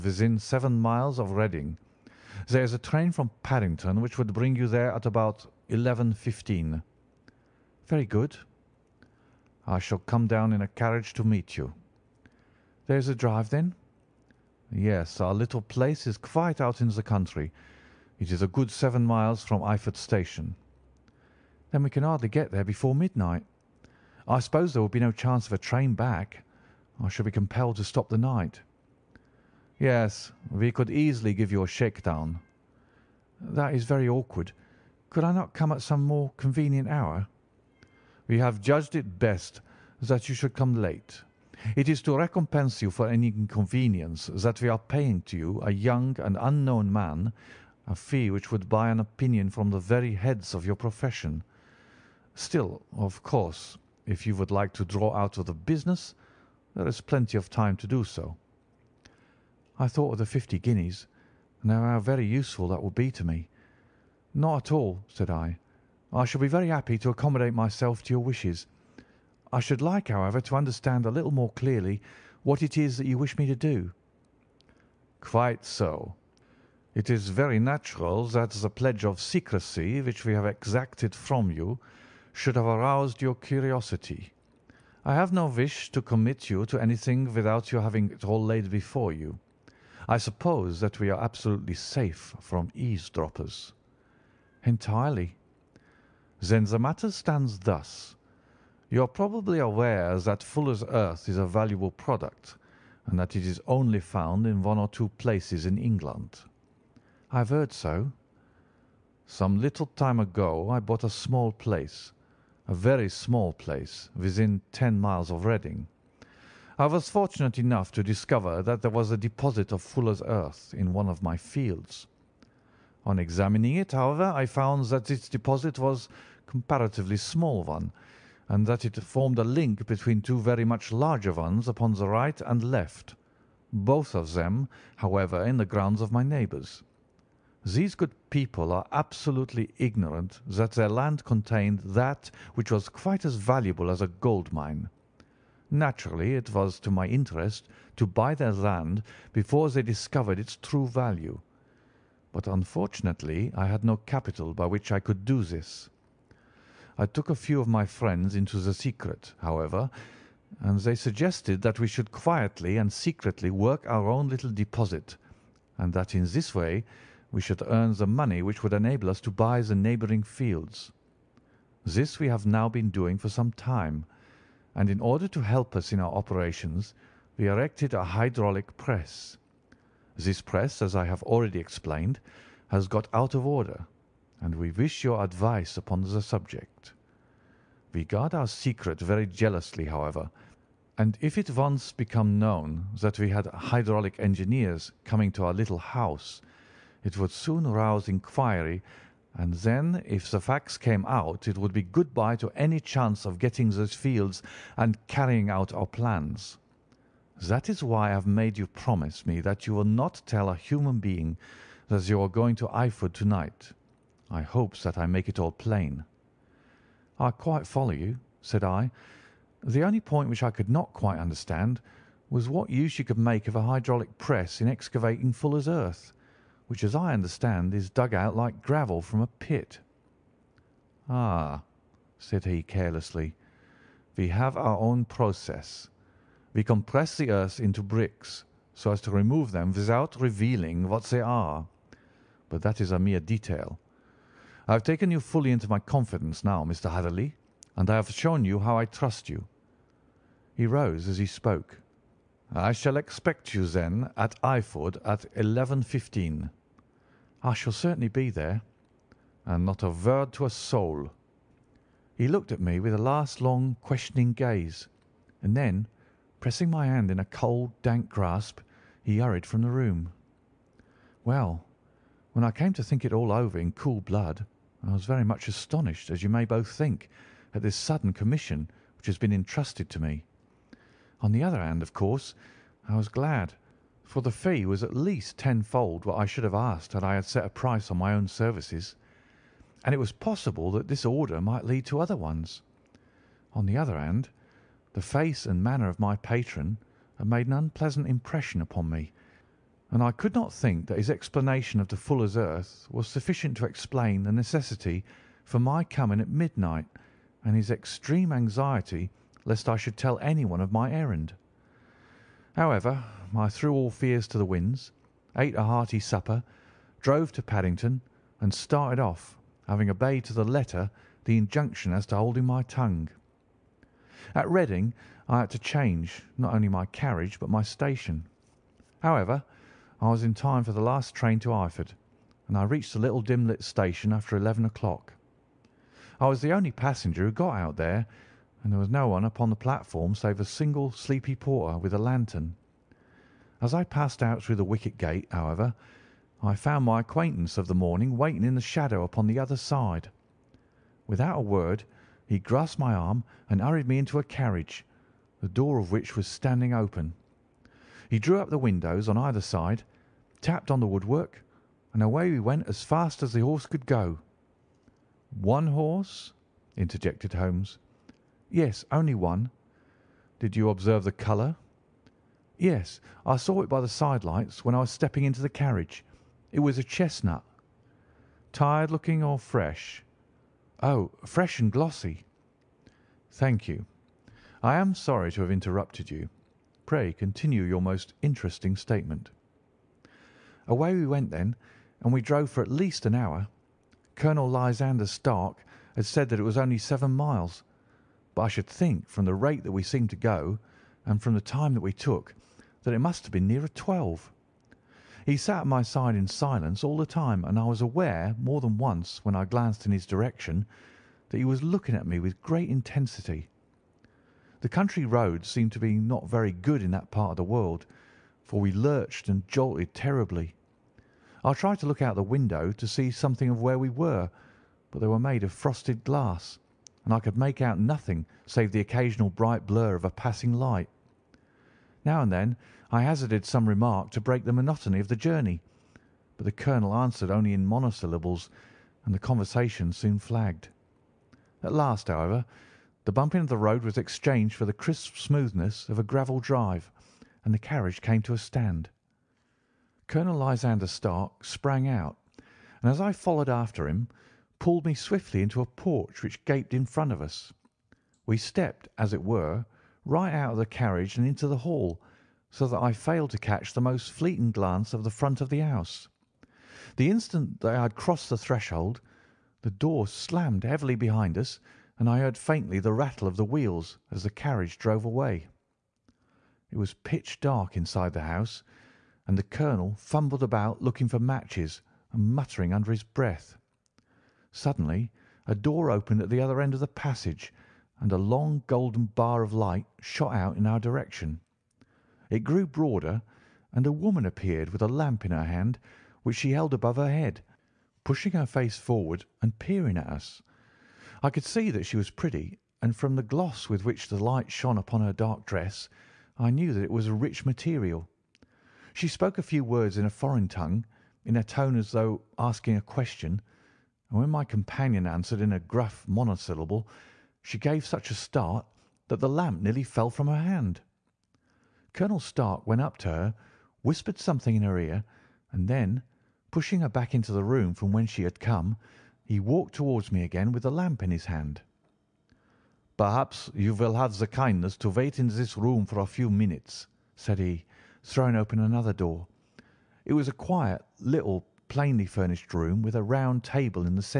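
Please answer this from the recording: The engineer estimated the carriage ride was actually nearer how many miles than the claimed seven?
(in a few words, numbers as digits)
12.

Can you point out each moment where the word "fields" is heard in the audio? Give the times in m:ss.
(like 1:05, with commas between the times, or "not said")
2:01, 2:50, 3:23.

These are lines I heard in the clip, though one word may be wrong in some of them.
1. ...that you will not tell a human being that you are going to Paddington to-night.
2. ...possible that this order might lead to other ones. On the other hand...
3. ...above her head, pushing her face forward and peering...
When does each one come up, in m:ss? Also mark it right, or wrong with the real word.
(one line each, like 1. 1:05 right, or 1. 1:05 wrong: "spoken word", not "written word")
1. 3:29 wrong: "Eyford", not "Paddington"
2. 4:50 right
3. 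8:16 right.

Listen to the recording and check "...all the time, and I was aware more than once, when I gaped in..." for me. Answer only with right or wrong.
wrong.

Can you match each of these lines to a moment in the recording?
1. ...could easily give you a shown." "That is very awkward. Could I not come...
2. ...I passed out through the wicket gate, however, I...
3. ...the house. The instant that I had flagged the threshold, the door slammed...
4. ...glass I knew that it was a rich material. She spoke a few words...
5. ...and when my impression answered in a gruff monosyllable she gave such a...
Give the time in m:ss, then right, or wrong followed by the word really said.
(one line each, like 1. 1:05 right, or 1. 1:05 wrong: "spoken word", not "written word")
1. 0:30 wrong: "shakedown", not "shown"
2. 5:43 right
3. 7:45 wrong: "crossed", not "flagged"
4. 8:25 wrong: "dress", not "glass"
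5. 8:34 wrong: "companion", not "impression".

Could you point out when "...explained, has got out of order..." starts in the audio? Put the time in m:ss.
3:01.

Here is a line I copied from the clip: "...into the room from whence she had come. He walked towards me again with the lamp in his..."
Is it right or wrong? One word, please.
right.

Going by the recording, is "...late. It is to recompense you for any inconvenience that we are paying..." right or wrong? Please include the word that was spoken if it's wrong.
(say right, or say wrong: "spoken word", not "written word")
right.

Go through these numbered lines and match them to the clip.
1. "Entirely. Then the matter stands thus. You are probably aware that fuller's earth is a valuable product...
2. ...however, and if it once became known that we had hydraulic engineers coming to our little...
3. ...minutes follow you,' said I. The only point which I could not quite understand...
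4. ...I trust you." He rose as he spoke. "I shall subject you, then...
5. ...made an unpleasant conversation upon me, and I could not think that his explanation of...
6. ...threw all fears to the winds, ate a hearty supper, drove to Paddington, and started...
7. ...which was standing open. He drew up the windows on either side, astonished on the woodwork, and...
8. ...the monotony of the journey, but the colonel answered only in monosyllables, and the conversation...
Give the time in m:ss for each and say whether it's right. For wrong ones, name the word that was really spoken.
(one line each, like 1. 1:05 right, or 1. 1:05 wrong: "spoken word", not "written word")
1. 1:34 right
2. 3:09 right
3. 3:37 wrong: "quite", not "minutes"
4. 4:08 wrong: "expect", not "subject"
5. 4:57 wrong: "impression", not "conversation"
6. 5:13 right
7. 5:55 wrong: "tapped", not "astonished"
8. 7:14 right.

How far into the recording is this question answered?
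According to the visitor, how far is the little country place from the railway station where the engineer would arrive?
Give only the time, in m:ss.
0:18.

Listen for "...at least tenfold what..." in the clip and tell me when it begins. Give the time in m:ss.
4:44.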